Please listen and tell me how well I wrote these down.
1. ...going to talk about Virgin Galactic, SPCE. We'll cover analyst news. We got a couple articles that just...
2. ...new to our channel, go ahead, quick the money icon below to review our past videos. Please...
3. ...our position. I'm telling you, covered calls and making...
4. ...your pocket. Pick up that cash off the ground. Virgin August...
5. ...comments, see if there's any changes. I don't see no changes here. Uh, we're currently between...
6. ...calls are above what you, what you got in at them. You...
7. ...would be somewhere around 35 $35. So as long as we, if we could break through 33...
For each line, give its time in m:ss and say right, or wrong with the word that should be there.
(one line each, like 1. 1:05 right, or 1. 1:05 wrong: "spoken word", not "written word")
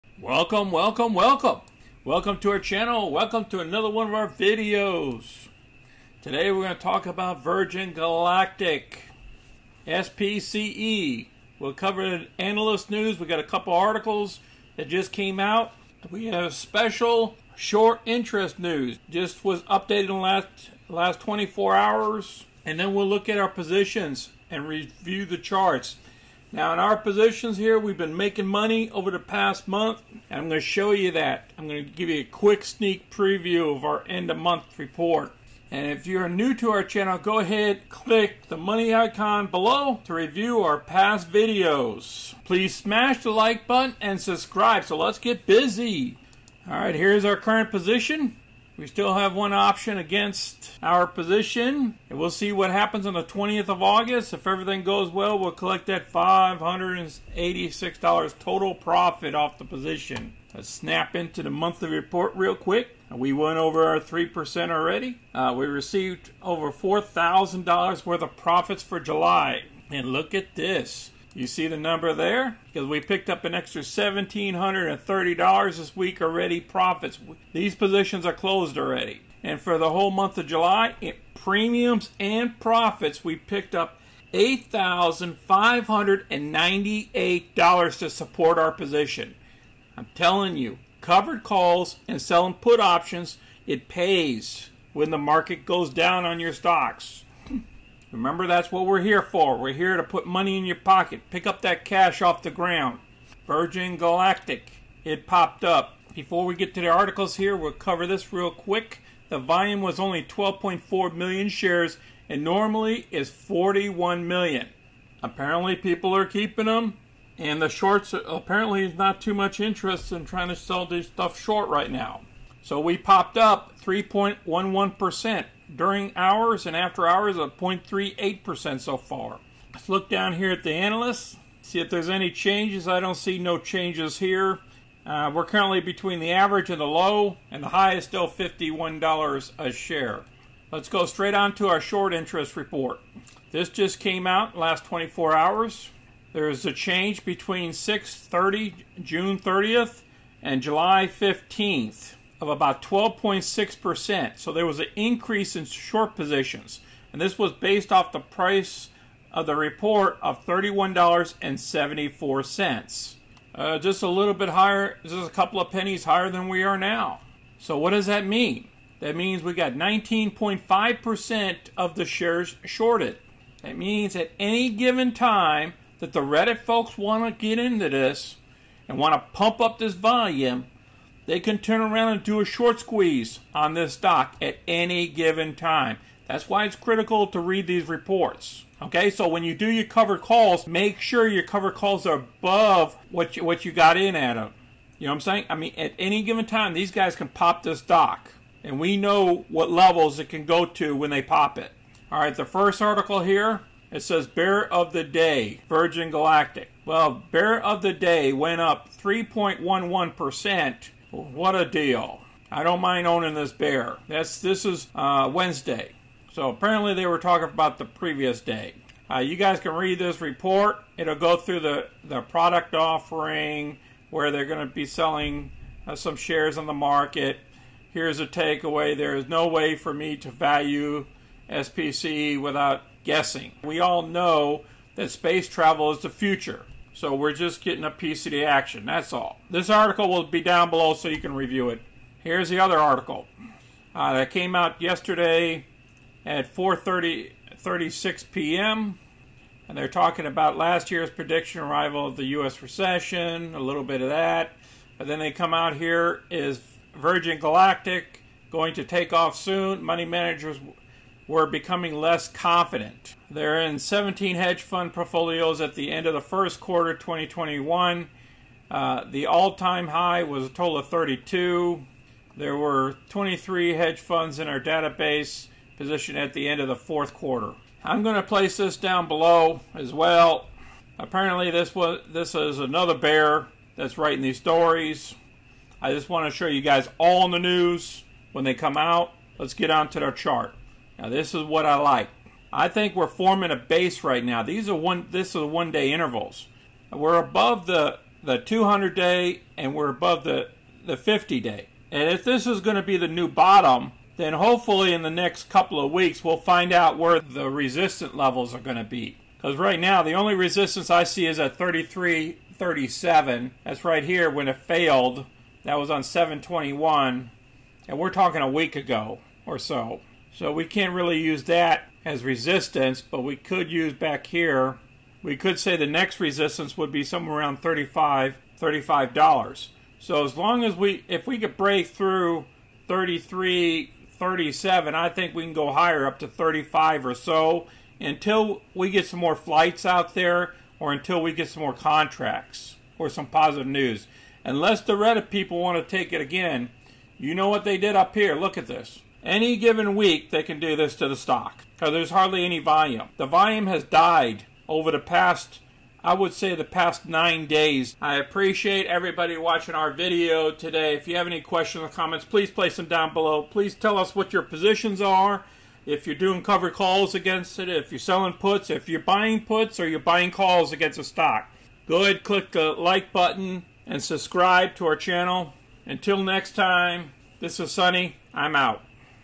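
1. 0:06 right
2. 0:36 wrong: "click", not "quick"
3. 1:28 wrong: "selling", not "making"
4. 1:40 wrong: "Galactic", not "August"
5. 2:10 wrong: "analysts", not "comments"
6. 3:11 right
7. 5:26 right.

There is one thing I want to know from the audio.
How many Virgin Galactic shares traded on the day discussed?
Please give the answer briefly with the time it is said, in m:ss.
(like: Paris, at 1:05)
12.4 million, at 1:50.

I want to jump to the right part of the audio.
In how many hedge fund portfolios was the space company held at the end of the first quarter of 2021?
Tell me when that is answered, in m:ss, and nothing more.
4:23.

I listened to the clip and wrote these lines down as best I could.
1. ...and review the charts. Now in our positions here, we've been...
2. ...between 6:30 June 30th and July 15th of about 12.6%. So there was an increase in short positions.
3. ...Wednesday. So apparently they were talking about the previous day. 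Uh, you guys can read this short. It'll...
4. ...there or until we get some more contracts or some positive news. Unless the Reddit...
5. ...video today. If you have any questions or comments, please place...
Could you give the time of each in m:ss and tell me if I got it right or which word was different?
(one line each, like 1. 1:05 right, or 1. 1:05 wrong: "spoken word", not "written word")
1. 0:24 right
2. 2:27 right
3. 3:35 wrong: "report", not "short"
4. 5:40 right
5. 5:59 right.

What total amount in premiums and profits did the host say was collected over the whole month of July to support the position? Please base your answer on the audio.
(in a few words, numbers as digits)
$8,598.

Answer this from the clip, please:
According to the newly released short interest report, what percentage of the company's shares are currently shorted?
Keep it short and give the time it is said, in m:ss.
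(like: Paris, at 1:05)
19.5%, at 2:49.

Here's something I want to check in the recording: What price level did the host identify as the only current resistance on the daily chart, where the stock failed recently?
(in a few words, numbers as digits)
$33.37.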